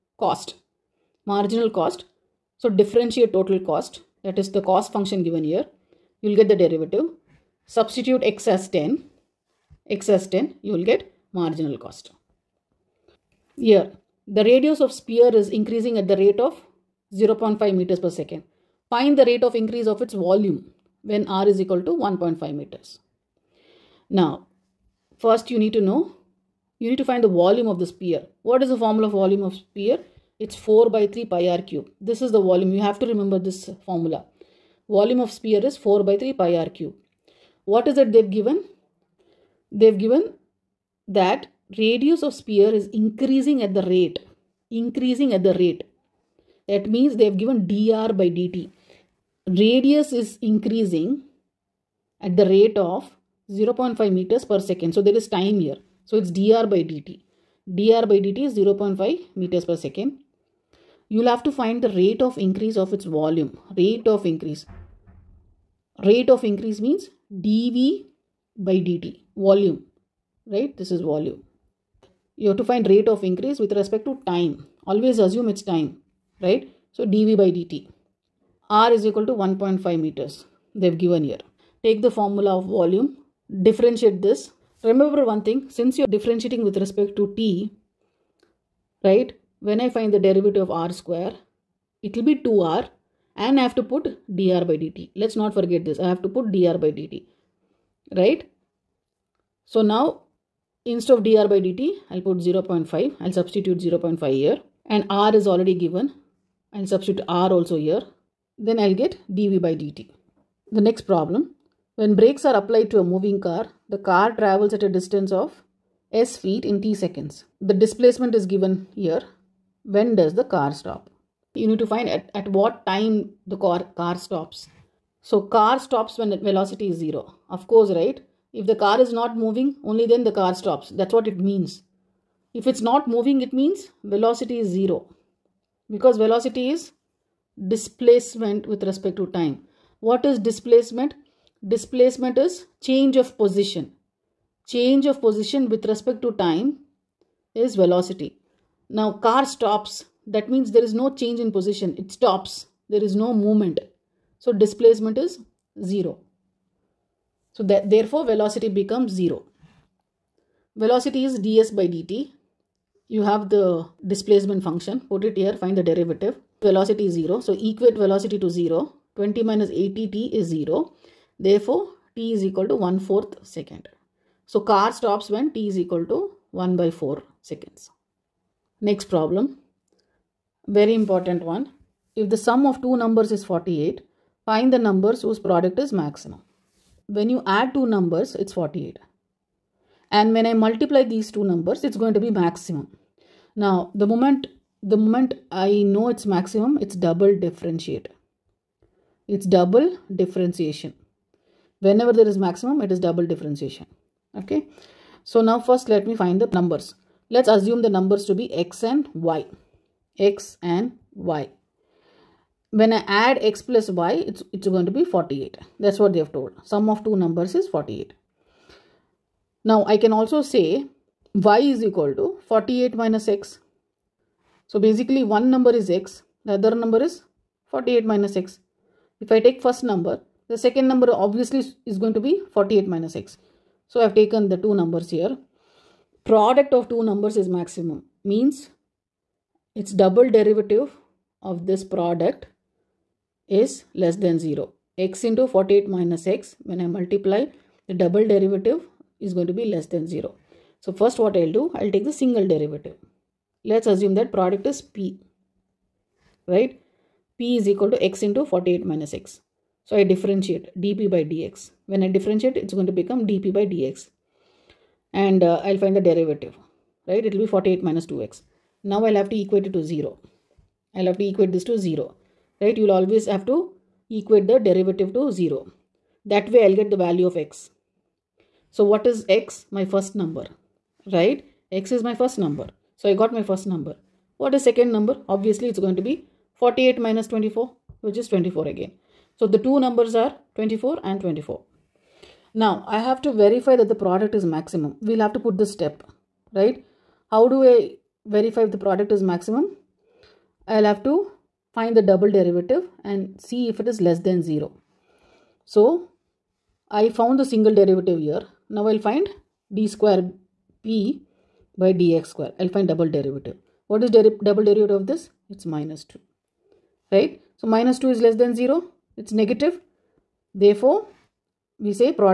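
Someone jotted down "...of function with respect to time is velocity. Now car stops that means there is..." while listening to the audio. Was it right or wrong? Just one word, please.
wrong.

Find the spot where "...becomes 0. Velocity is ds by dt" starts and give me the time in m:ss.
2:38.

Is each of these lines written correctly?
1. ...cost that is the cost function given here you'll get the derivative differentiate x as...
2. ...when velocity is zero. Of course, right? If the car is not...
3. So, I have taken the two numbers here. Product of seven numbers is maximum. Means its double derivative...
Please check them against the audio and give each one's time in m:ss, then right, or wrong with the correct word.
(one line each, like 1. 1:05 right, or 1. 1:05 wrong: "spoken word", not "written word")
1. 0:03 wrong: "substitute", not "differentiate"
2. 2:06 right
3. 3:53 wrong: "two", not "seven".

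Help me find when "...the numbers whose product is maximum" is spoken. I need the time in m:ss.
3:04.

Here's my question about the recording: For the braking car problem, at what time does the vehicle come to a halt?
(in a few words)
1/4 second.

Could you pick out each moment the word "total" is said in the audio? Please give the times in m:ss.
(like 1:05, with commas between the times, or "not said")
0:03.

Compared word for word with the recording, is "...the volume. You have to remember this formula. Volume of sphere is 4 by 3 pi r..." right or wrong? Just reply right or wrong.
right.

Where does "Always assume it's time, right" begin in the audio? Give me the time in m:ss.
1:14.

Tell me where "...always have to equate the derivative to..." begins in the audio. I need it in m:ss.
4:32.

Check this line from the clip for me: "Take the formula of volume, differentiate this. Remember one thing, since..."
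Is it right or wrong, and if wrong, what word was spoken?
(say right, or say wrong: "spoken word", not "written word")
right.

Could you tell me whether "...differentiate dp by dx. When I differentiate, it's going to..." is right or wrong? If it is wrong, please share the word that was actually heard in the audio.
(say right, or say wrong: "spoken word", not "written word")
right.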